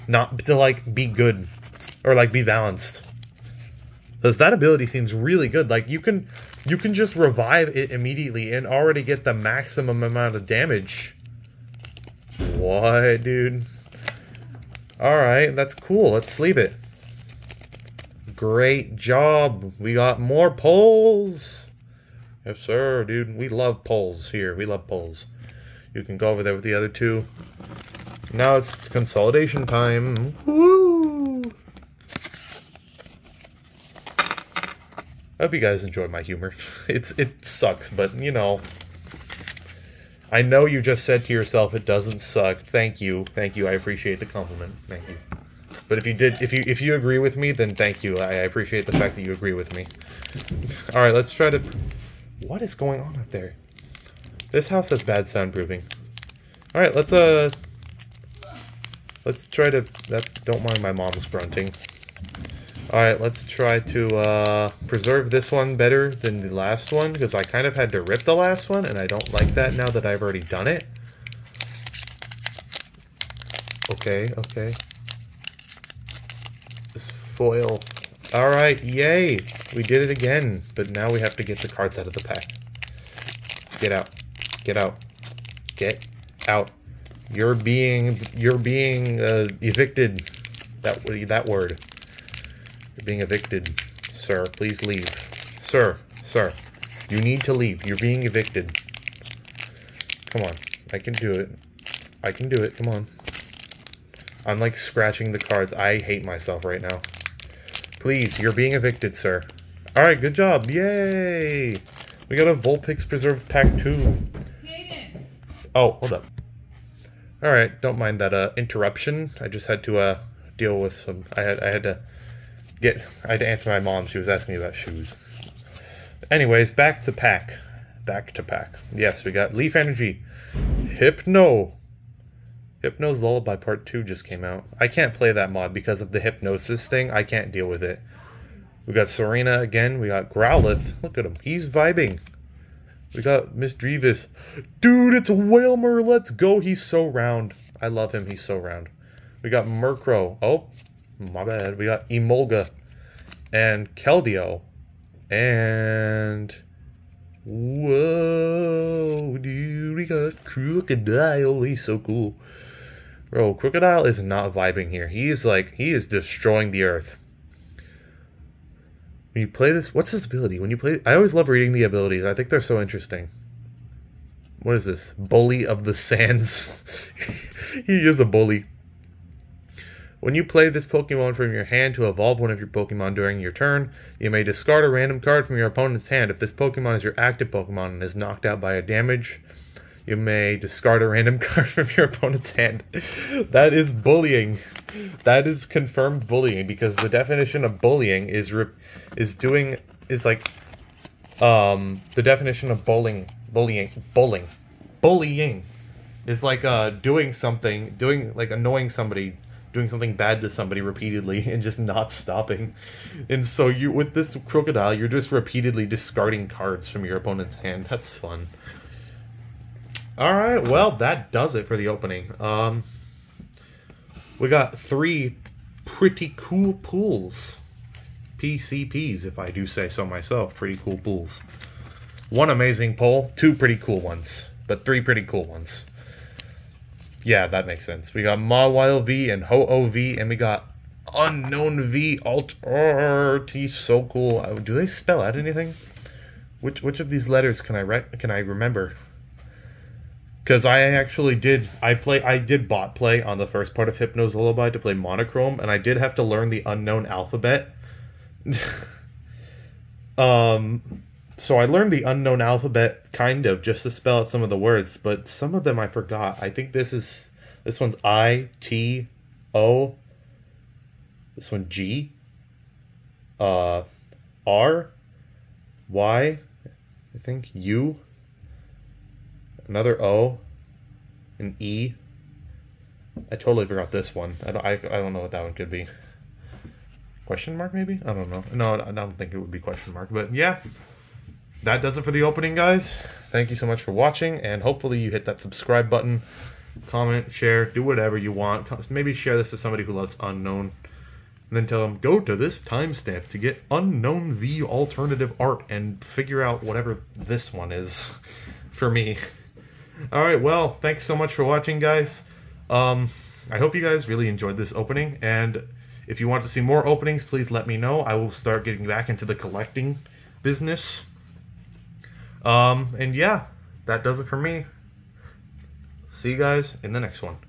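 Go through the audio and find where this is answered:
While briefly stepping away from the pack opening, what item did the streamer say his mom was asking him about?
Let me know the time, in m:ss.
2:04.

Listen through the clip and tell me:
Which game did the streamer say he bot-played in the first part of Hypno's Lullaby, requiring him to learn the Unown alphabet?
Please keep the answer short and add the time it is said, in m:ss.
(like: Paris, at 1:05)
Monochrome, at 4:14.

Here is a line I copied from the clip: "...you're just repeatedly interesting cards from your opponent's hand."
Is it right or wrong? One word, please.
wrong.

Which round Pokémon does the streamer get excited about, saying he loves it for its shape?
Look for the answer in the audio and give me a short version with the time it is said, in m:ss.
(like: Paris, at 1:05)
Wailmer, at 2:25.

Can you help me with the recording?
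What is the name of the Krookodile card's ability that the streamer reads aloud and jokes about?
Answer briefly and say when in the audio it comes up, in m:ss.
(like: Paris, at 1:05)
Bully of the Sands, at 2:55.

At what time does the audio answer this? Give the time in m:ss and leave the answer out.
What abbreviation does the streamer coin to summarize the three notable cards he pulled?
3:48.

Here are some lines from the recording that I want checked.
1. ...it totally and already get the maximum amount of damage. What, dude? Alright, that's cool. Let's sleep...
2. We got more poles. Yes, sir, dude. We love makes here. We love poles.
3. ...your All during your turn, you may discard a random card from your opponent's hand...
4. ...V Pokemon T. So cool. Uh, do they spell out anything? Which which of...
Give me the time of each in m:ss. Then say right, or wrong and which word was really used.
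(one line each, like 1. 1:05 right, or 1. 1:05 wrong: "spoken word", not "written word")
1. 0:07 wrong: "immediately", not "totally"
2. 0:19 wrong: "poles", not "makes"
3. 3:02 wrong: "Pokemon", not "All"
4. 4:01 wrong: "Alt", not "Pokemon".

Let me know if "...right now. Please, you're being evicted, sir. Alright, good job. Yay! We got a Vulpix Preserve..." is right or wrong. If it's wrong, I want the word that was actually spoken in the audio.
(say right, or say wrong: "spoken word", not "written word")
right.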